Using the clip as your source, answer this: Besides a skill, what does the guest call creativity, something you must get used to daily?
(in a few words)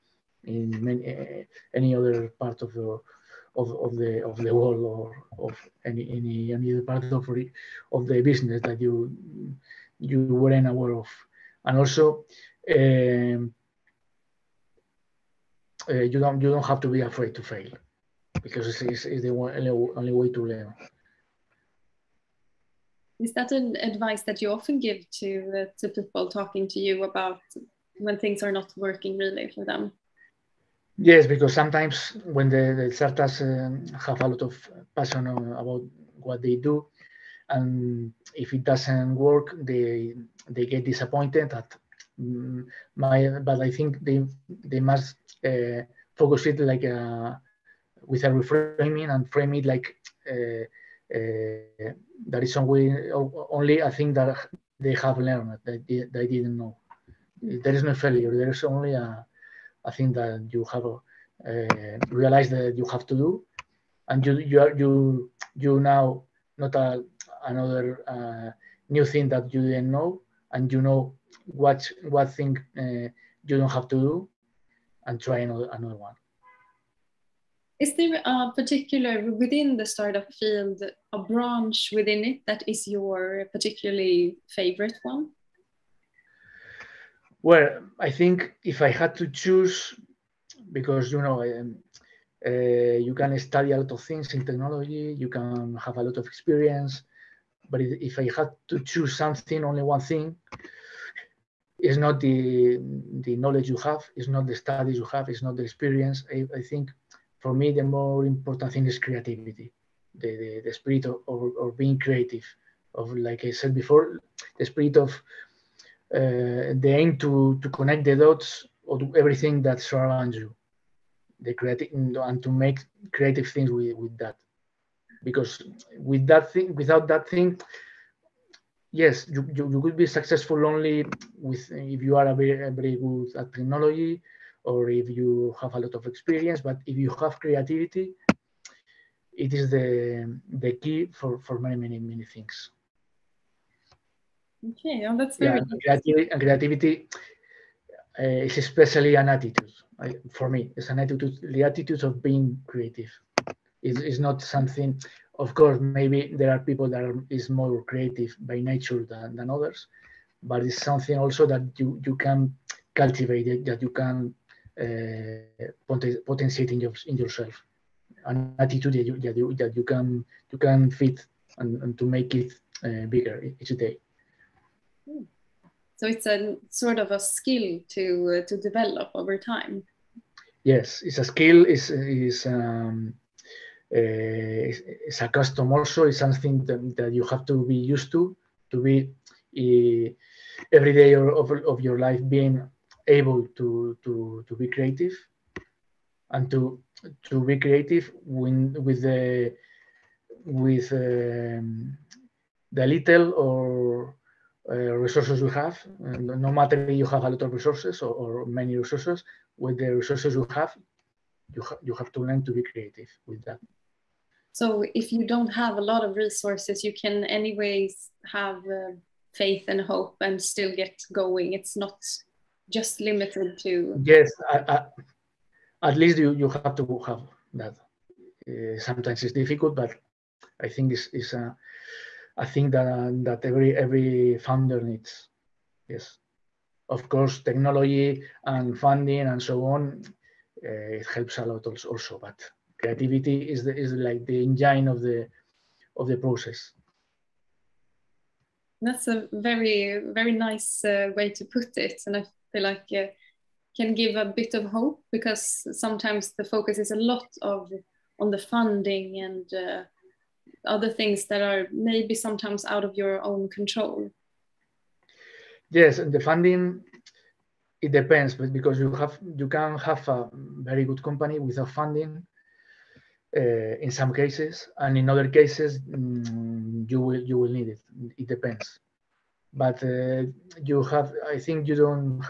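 a custom.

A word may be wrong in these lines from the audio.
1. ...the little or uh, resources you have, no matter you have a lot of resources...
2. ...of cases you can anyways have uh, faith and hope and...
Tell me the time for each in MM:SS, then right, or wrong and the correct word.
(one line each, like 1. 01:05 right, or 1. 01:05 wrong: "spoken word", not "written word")
1. 03:22 right
2. 03:36 wrong: "resources", not "cases".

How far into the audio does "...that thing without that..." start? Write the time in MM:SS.
02:06.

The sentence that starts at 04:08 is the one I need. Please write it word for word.
That's a very, very nice uh, way to put it.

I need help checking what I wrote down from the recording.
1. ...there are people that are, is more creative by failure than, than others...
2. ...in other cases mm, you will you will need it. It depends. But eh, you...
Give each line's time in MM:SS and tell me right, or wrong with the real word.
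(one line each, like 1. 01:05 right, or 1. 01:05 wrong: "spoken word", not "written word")
1. 02:36 wrong: "nature", not "failure"
2. 04:34 right.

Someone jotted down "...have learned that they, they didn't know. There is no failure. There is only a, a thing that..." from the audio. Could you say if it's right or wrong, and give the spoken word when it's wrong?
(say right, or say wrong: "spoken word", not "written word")
right.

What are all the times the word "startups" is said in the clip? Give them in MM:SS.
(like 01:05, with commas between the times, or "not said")
00:32, 01:19.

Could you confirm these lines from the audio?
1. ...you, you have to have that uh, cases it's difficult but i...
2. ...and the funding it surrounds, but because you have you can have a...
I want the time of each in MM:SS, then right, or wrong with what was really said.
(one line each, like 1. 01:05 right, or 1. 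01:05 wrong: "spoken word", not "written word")
1. 03:46 wrong: "sometimes", not "cases"
2. 04:25 wrong: "depends", not "surrounds".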